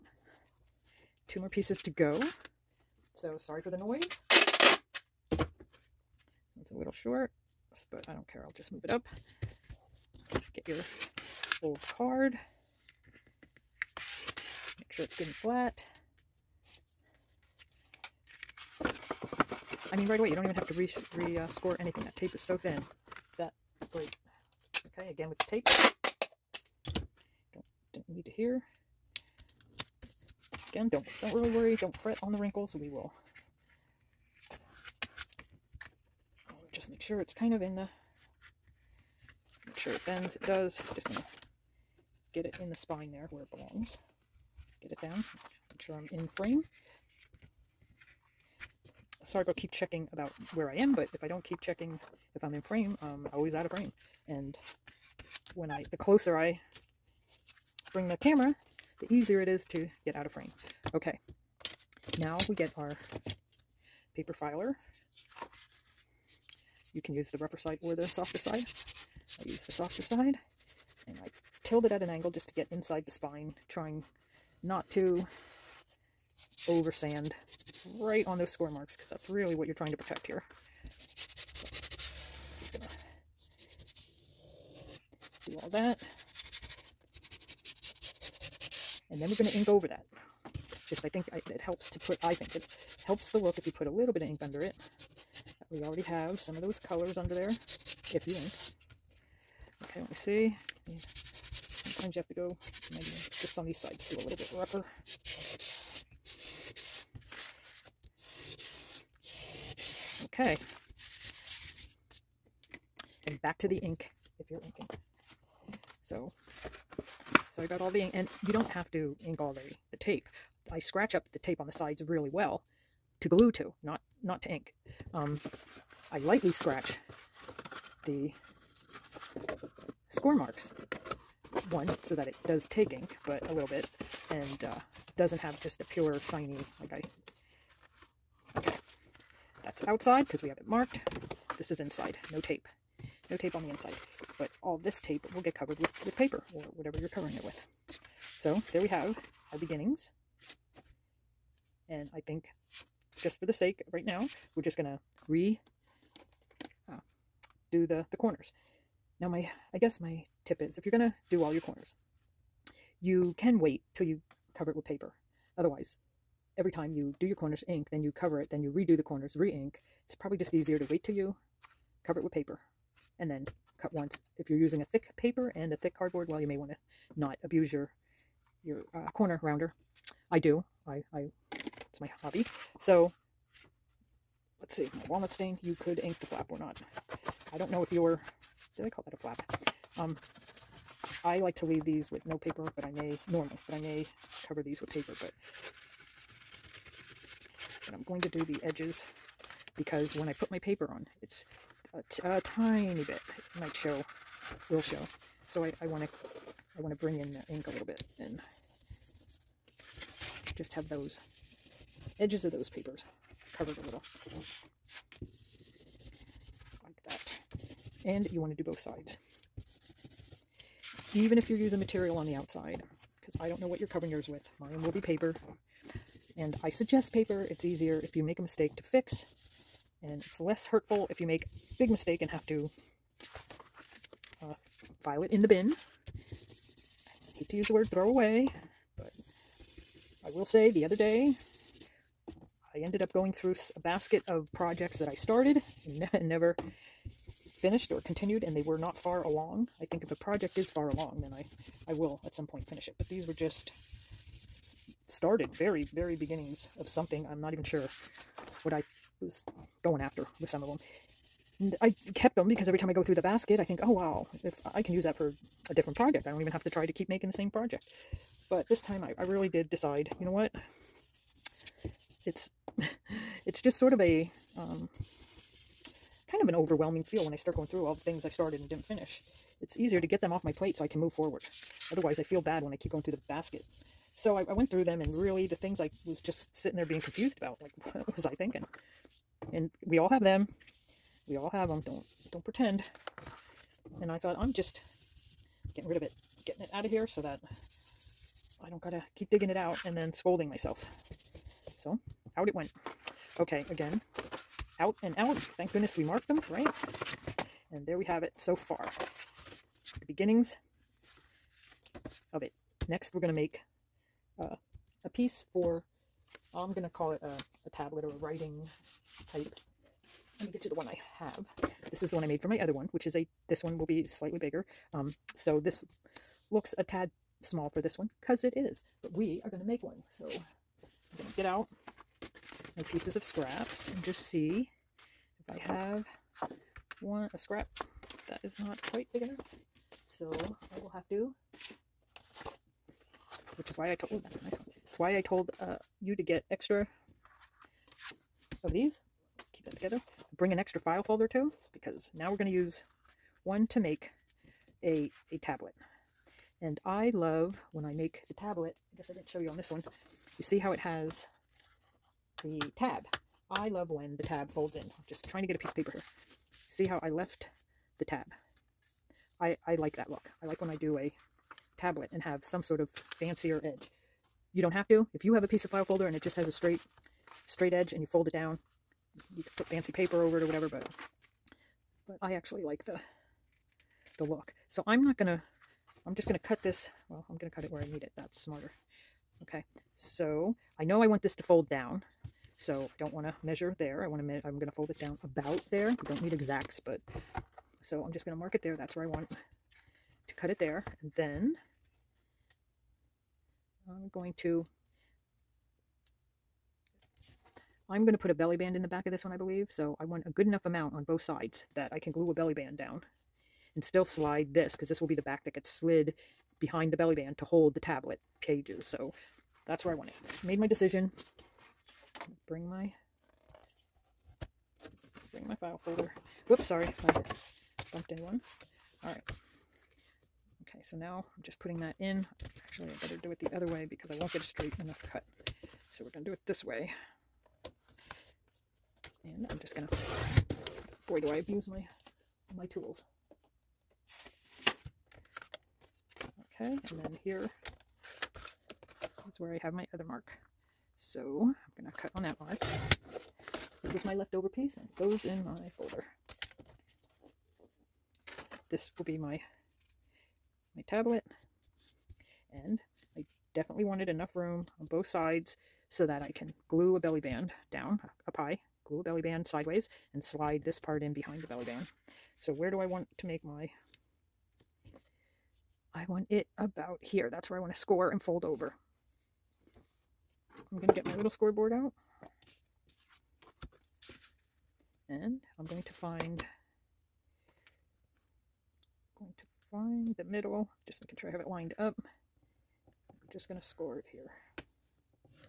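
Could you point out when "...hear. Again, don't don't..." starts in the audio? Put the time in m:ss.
0:28.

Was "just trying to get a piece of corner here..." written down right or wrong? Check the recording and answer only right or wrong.
wrong.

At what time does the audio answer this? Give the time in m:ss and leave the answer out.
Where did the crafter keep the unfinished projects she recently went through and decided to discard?
4:03.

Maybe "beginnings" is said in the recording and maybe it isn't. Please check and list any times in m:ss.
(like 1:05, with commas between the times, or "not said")
2:29, 4:16, 5:10.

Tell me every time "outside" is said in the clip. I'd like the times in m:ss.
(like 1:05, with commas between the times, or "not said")
2:19, 3:42.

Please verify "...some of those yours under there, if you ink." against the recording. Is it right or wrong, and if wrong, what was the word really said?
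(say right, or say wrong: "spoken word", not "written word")
wrong: "colors", not "yours".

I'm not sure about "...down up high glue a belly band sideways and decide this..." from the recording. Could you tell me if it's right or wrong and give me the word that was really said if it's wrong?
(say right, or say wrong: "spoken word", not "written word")
wrong: "slide", not "decide".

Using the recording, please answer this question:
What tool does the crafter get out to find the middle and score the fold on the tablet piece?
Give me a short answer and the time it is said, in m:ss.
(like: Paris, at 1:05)
Scoreboard, at 8:01.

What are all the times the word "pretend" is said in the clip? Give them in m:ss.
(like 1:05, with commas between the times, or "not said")
4:52.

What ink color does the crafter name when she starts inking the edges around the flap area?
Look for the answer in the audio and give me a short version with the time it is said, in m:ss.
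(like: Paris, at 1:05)
Walnut stain, at 3:05.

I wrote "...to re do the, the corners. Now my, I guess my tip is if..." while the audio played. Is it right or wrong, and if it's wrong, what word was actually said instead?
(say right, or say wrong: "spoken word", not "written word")
right.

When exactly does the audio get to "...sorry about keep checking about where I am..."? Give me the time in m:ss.
0:49.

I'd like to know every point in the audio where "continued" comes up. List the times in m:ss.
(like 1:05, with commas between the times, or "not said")
4:08.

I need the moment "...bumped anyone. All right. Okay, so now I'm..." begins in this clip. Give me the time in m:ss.
7:07.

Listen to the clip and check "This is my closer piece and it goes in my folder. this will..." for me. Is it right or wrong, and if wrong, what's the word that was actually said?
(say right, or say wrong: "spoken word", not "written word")
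wrong: "leftover", not "closer".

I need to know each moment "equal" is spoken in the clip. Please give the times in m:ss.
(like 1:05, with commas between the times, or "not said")
not said.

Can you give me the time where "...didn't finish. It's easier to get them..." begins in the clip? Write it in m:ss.
4:38.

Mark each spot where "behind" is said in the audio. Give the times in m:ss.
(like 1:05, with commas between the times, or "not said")
6:56, 7:51.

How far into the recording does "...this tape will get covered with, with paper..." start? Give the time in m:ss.
2:24.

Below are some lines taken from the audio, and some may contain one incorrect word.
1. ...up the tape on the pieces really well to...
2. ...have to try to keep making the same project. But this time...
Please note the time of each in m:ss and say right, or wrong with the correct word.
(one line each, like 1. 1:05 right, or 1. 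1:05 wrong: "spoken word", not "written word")
1. 2:01 wrong: "sides", not "pieces"
2. 4:26 right.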